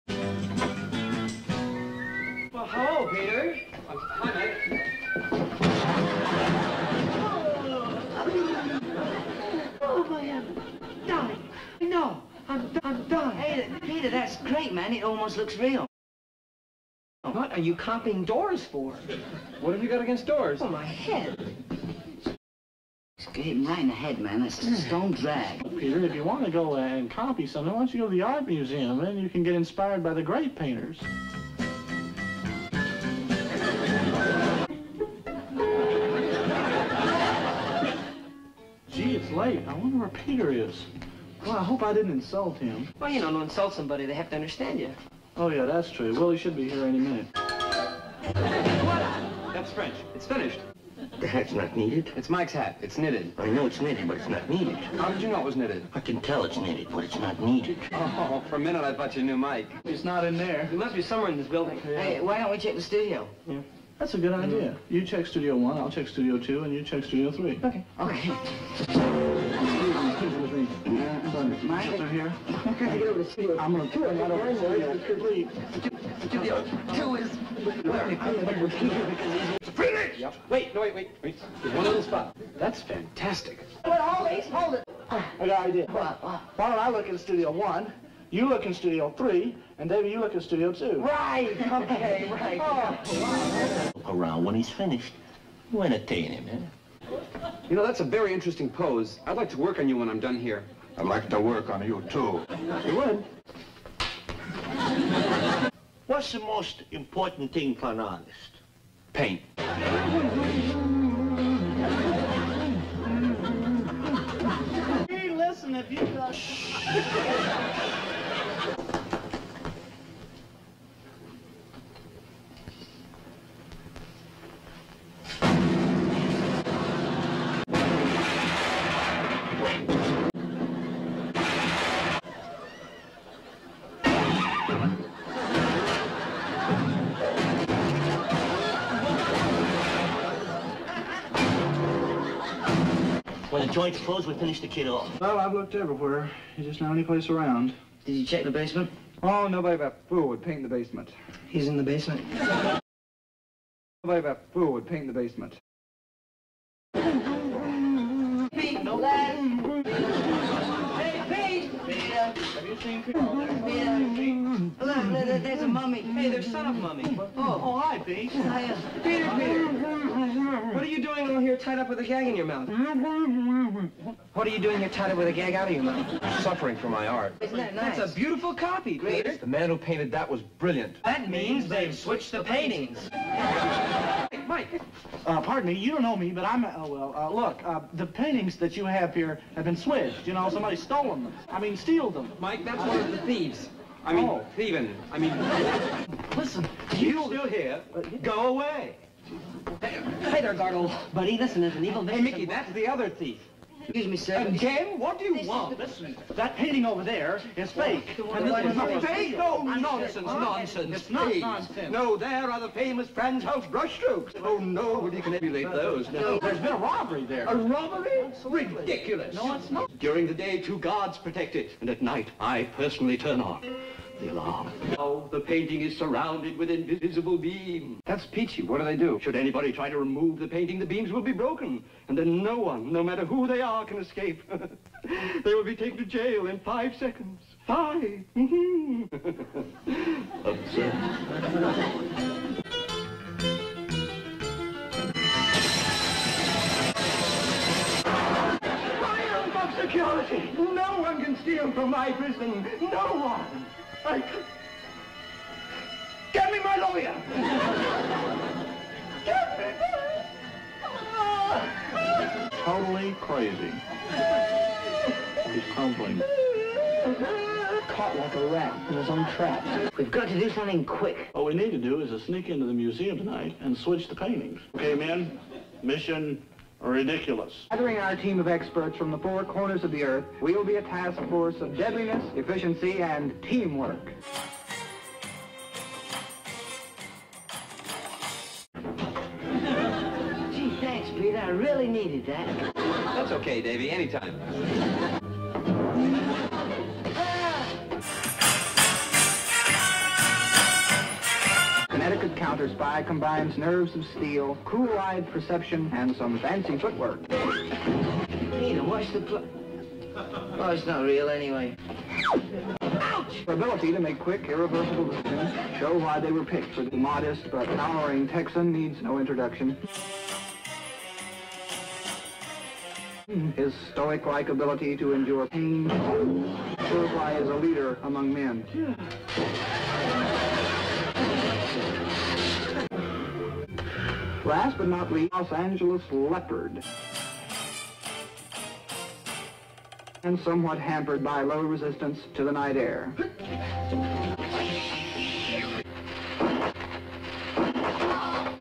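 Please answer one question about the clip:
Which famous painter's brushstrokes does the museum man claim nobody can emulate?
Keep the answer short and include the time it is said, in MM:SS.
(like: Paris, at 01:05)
Frans Hals, at 03:33.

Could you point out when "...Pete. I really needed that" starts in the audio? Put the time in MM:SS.
04:51.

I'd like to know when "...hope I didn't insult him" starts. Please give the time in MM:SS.
00:41.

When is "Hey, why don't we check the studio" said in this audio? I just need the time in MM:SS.
01:02.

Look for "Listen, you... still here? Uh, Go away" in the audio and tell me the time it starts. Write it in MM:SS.
03:16.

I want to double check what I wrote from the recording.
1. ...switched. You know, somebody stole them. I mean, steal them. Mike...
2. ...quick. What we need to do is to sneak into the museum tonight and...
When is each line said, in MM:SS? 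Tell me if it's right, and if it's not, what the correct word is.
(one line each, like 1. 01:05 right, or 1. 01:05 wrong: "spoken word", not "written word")
1. 03:09 right
2. 04:30 right.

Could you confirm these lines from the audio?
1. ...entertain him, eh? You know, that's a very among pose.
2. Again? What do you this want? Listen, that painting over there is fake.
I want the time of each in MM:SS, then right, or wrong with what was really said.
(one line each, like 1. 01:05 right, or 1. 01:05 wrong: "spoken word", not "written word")
1. 01:35 wrong: "interesting", not "among"
2. 03:24 right.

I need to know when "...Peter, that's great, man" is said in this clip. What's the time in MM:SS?
00:13.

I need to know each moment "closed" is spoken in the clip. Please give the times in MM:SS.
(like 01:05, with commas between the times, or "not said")
02:23.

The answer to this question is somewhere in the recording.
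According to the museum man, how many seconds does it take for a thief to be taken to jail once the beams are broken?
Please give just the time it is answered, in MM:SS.
03:56.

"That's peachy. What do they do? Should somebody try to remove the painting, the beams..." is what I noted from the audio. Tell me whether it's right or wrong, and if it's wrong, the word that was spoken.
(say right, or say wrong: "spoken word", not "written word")
wrong: "anybody", not "somebody".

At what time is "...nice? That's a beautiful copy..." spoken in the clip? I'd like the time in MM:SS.
02:57.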